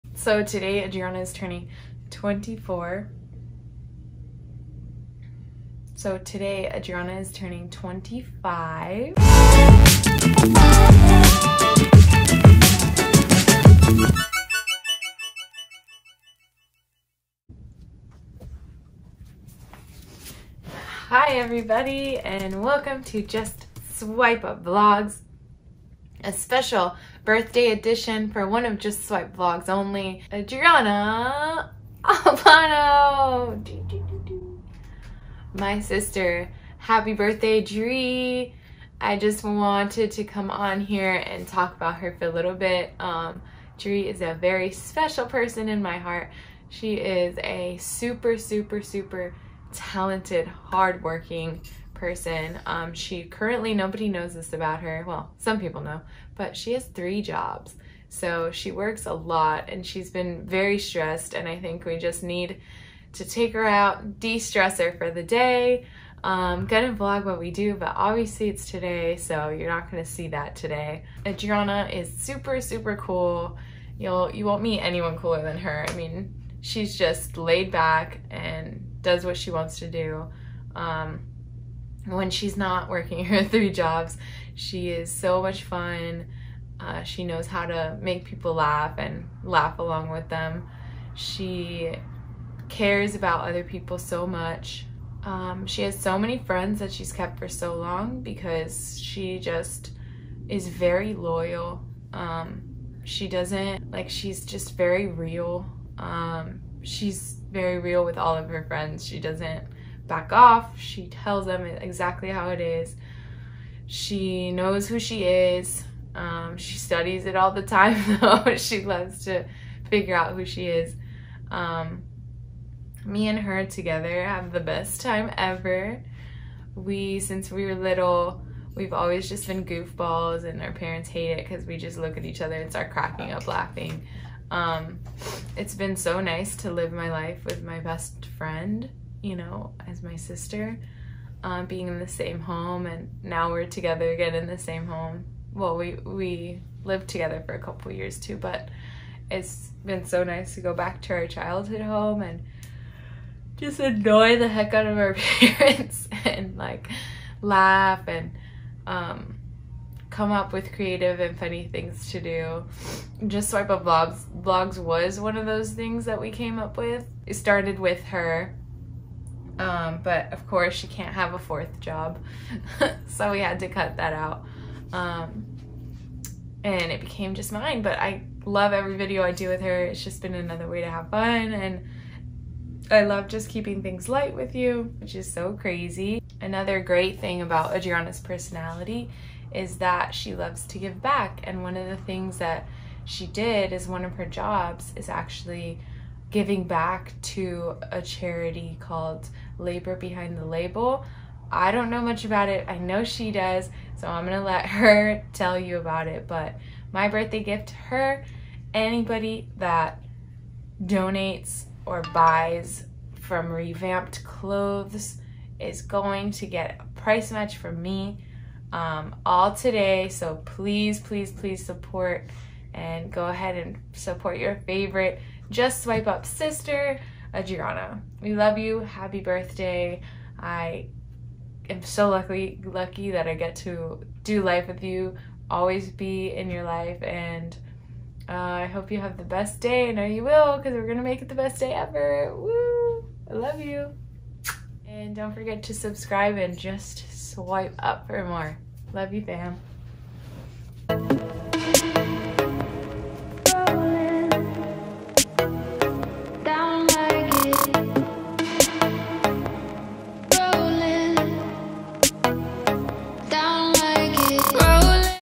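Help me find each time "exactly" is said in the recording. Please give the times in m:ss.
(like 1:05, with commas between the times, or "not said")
1:51.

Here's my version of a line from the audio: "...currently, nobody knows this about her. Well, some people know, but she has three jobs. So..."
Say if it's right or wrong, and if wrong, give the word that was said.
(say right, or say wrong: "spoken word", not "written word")
right.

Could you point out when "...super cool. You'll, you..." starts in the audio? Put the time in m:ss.
1:12.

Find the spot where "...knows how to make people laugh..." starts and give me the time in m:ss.
1:27.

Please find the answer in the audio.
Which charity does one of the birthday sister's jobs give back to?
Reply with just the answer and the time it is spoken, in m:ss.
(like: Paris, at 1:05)
Labor Behind the Label, at 3:19.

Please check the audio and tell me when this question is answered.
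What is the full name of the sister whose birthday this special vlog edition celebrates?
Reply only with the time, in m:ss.
0:30.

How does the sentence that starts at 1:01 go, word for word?
And I think we just need to take her out, de-stress her for the day.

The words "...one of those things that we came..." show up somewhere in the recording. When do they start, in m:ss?
2:45.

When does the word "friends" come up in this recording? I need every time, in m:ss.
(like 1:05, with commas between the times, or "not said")
1:36, 1:48, 2:18.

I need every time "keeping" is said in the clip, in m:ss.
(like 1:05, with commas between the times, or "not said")
3:03.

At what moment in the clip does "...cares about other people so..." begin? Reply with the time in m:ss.
1:32.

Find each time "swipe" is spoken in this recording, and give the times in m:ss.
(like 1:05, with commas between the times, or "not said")
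0:29, 2:43, 3:45, 4:07.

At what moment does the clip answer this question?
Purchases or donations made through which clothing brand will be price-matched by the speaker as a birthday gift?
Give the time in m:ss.
3:33.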